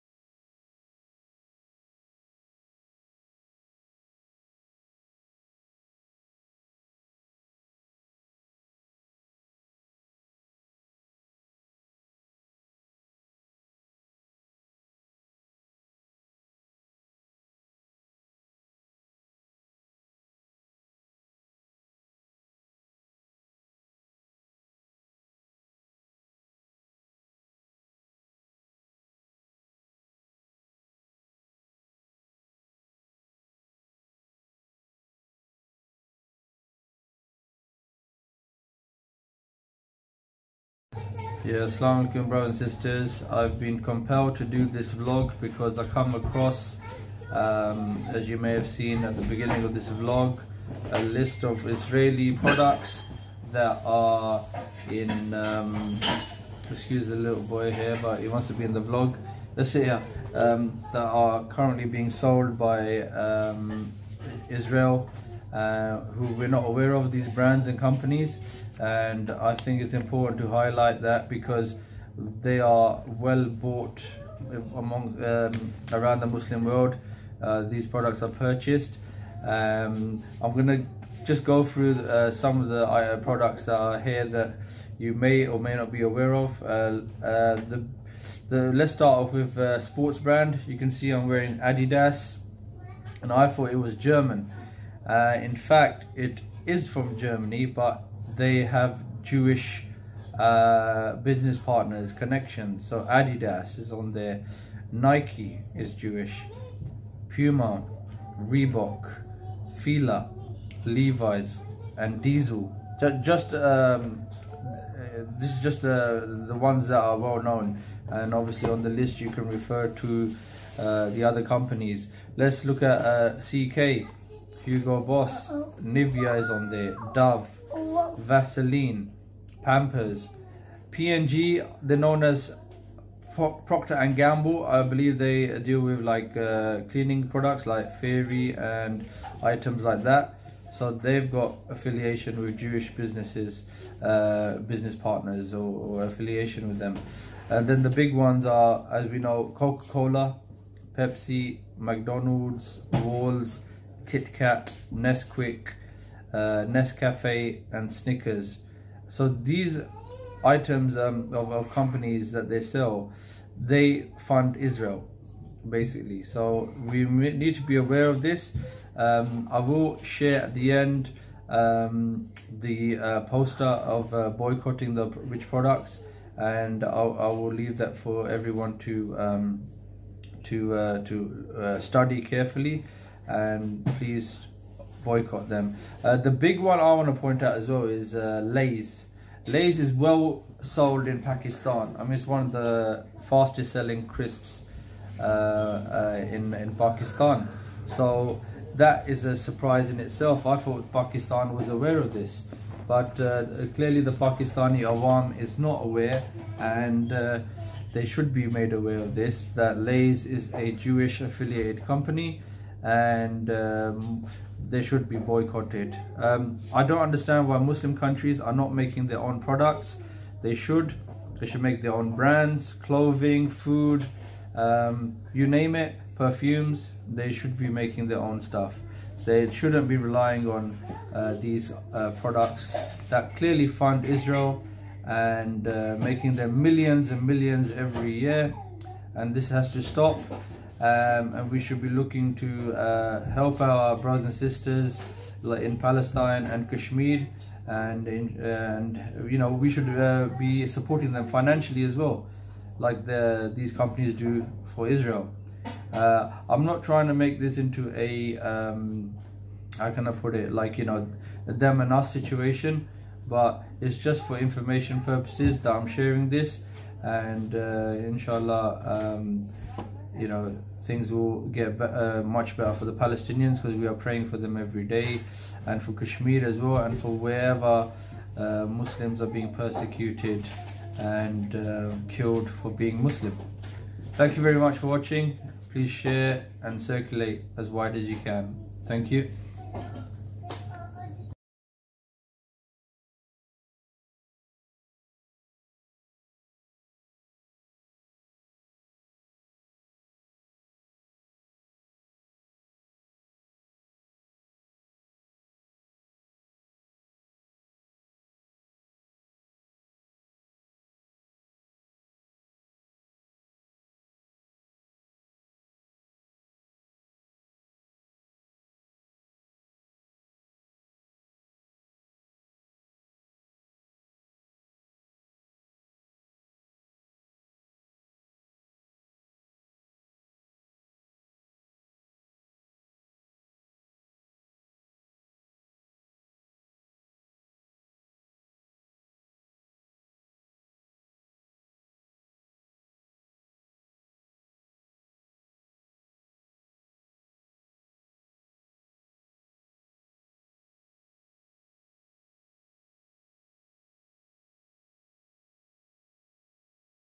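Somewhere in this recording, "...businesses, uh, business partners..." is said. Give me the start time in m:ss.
2:22.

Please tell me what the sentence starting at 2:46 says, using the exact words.
So we need to be aware of this.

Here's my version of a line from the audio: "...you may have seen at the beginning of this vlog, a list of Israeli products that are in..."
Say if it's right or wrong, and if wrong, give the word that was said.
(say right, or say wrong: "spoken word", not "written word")
right.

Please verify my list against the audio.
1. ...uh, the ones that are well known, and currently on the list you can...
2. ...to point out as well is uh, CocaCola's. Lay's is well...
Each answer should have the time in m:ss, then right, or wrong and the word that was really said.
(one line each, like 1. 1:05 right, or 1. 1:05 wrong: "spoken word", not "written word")
1. 1:55 wrong: "obviously", not "currently"
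2. 3:07 wrong: "Lay", not "CocaCola".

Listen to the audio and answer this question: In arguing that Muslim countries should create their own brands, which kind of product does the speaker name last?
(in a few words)
Perfumes.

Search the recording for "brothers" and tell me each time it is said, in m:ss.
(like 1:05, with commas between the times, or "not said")
0:42, 4:03.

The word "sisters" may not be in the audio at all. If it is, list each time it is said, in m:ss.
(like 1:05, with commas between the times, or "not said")
0:42, 4:04.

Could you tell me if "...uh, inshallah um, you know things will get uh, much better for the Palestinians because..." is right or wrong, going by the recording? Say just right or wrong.
right.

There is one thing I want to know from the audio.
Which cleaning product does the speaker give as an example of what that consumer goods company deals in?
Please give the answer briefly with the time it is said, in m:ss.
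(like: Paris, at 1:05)
Fairy, at 2:17.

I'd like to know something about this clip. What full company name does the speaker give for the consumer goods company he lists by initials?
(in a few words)
Procter and Gamble.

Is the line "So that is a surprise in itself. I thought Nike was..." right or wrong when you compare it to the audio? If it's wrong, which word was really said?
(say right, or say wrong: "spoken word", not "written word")
wrong: "Pakistan", not "Nike".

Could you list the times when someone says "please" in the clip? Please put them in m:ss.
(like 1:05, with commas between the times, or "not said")
3:03, 4:45.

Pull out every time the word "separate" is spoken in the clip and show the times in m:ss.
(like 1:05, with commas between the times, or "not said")
not said.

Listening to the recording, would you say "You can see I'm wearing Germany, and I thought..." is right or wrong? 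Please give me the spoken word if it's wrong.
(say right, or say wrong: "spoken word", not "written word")
wrong: "Adidas", not "Germany".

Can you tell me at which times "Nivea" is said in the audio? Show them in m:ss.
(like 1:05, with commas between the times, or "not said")
2:05.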